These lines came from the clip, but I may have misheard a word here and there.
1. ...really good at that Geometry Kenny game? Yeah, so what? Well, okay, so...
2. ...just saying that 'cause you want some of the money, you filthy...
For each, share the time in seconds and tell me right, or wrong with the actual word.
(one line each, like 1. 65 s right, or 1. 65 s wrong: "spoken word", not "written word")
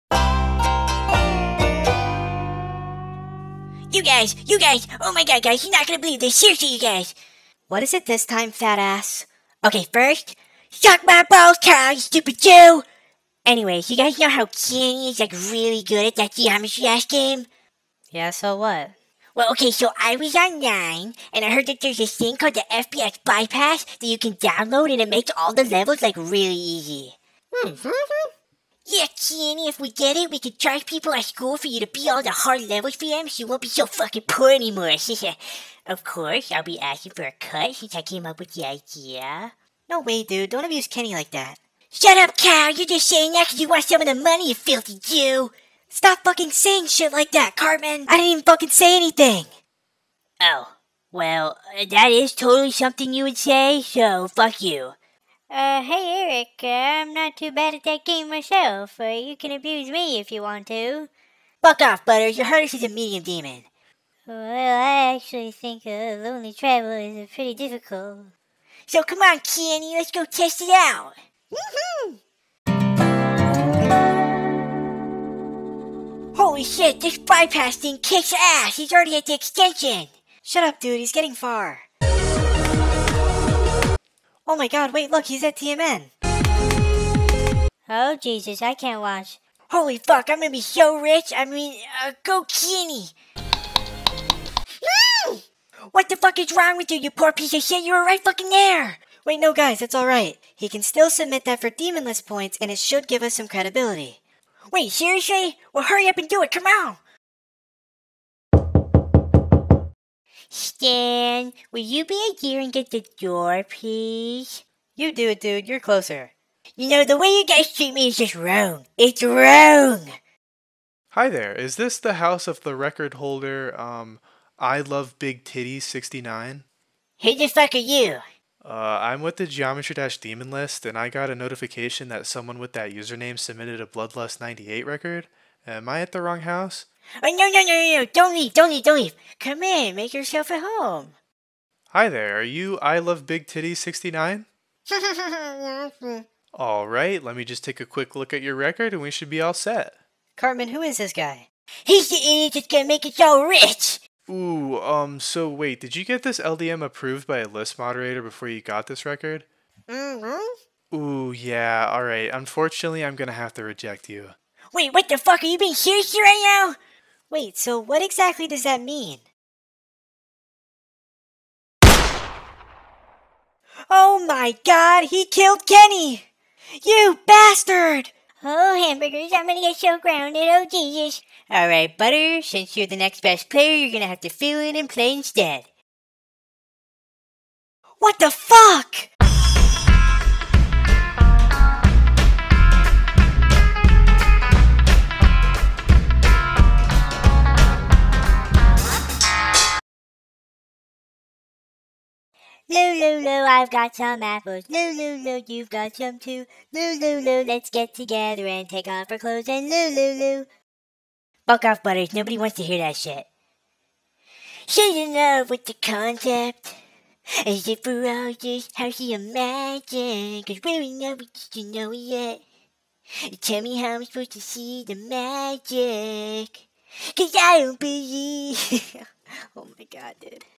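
1. 15 s wrong: "Dash", not "Kenny"
2. 42 s right.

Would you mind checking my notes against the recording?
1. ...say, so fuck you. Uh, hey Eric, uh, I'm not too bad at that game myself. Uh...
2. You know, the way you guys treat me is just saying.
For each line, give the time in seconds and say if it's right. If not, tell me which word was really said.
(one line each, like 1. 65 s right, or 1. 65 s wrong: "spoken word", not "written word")
1. 53 s right
2. 116 s wrong: "wrong", not "saying".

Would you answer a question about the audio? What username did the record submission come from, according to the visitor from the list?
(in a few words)
I Love Big Titties 69.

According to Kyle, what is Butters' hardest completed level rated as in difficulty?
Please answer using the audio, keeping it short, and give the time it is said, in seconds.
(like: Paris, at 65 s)
medium demon, at 62 s.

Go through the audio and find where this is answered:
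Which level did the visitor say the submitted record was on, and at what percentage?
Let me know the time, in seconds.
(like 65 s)
133 s.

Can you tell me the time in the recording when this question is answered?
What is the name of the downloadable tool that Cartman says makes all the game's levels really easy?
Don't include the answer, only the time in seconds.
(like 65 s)
22 s.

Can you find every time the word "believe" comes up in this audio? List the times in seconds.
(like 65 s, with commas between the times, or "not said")
5 s, 227 s.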